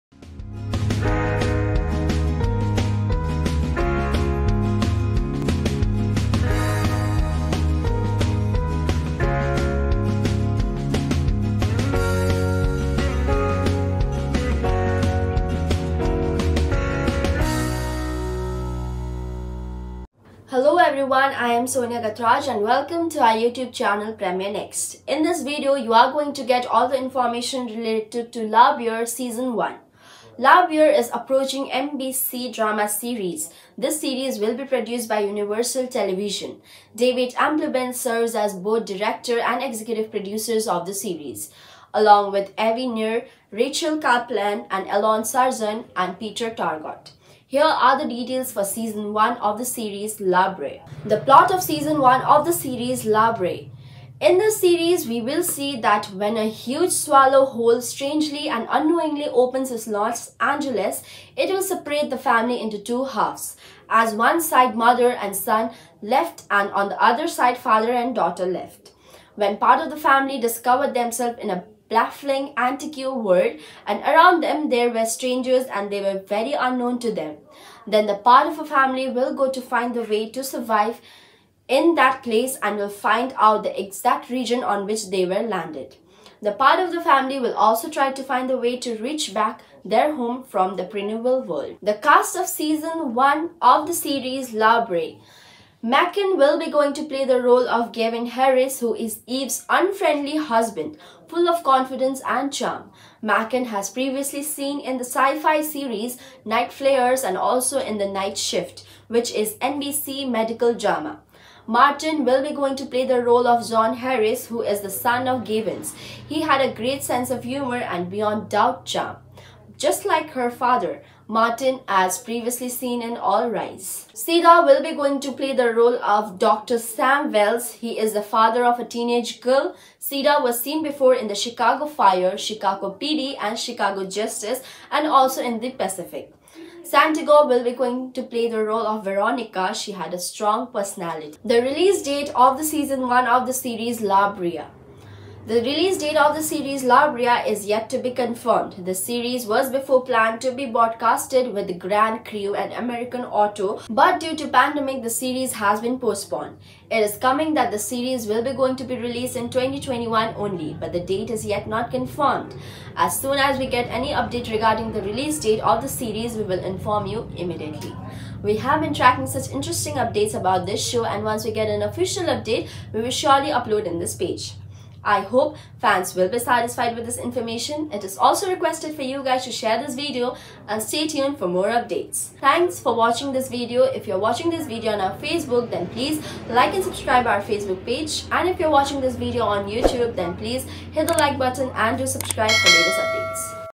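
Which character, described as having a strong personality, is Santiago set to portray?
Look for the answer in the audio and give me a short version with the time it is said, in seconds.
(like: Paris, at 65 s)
Veronica, at 139 s.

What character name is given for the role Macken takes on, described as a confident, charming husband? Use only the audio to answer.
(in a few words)
Gavin Harris.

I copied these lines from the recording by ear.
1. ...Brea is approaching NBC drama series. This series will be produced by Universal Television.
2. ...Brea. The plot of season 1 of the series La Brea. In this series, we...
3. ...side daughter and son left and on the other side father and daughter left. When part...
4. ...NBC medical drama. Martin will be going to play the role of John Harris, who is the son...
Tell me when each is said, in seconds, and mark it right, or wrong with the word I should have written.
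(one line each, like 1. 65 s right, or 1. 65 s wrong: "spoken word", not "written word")
1. 30 s right
2. 50 s right
3. 64 s wrong: "mother", not "daughter"
4. 109 s right.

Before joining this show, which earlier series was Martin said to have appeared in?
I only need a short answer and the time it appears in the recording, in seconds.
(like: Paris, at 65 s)
All Rise, at 123 s.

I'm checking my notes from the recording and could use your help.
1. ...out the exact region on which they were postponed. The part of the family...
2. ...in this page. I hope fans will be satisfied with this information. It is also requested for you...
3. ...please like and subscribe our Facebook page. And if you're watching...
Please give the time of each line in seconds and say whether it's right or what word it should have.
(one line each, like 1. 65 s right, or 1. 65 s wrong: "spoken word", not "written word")
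1. 83 s wrong: "landed", not "postponed"
2. 173 s right
3. 185 s right.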